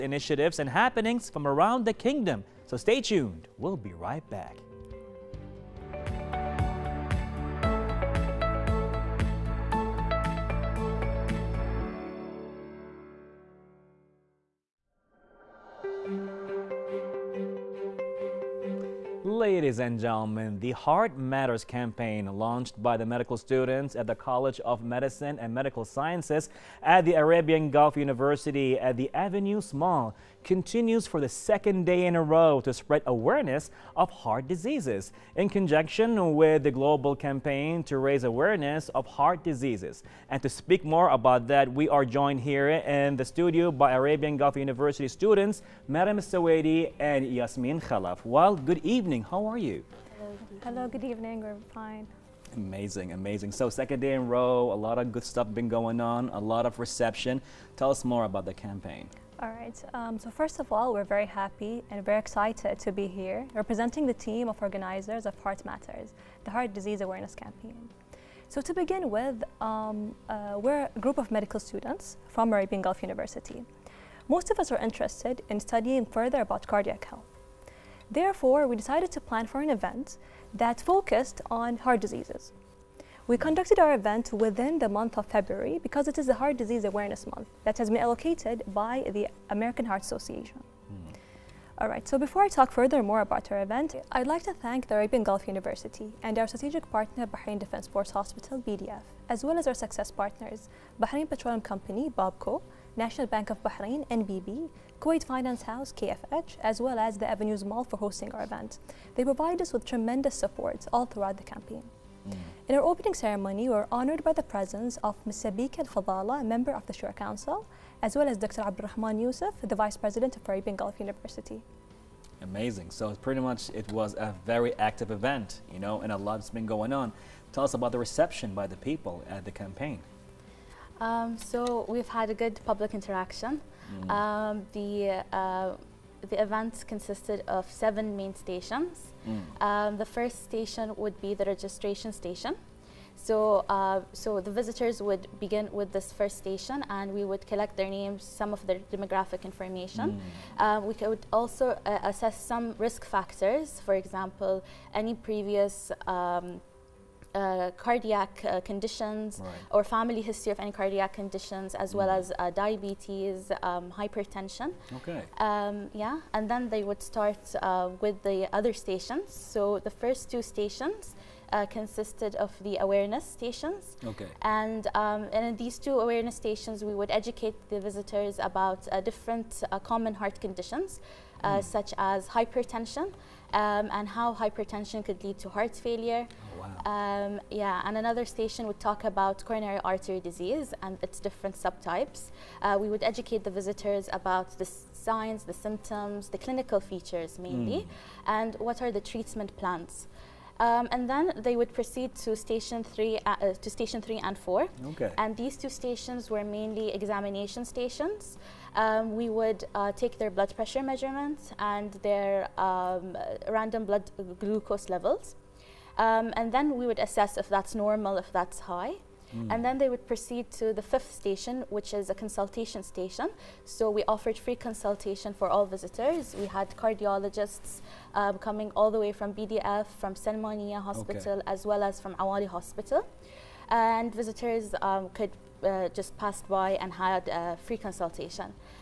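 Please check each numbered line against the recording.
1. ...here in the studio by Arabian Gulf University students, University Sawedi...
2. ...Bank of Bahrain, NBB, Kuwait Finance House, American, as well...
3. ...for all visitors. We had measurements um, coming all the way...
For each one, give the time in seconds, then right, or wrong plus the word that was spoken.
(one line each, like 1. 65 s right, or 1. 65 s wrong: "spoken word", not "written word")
1. 42 s wrong: "Mariam", not "University"
2. 103 s wrong: "KFH", not "American"
3. 225 s wrong: "cardiologists", not "measurements".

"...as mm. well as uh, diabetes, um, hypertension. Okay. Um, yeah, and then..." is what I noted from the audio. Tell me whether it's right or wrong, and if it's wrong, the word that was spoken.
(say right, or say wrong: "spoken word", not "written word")
right.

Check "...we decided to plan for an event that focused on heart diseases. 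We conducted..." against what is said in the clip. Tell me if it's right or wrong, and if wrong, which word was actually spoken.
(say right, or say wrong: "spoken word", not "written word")
right.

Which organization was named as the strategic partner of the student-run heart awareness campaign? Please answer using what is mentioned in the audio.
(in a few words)
Bahrain Defense Force Hospital.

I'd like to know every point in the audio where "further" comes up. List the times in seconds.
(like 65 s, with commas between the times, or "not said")
76 s, 92 s.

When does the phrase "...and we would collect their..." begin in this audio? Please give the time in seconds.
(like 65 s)
146 s.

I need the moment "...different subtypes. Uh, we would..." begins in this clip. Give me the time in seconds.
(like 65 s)
191 s.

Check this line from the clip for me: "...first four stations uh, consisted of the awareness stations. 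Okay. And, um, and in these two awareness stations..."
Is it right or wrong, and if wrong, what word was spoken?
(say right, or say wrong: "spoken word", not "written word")
wrong: "two", not "four".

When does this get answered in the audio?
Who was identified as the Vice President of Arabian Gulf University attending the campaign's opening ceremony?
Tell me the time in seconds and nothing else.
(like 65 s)
118 s.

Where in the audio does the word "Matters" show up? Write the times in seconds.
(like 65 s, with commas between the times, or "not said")
21 s, 65 s.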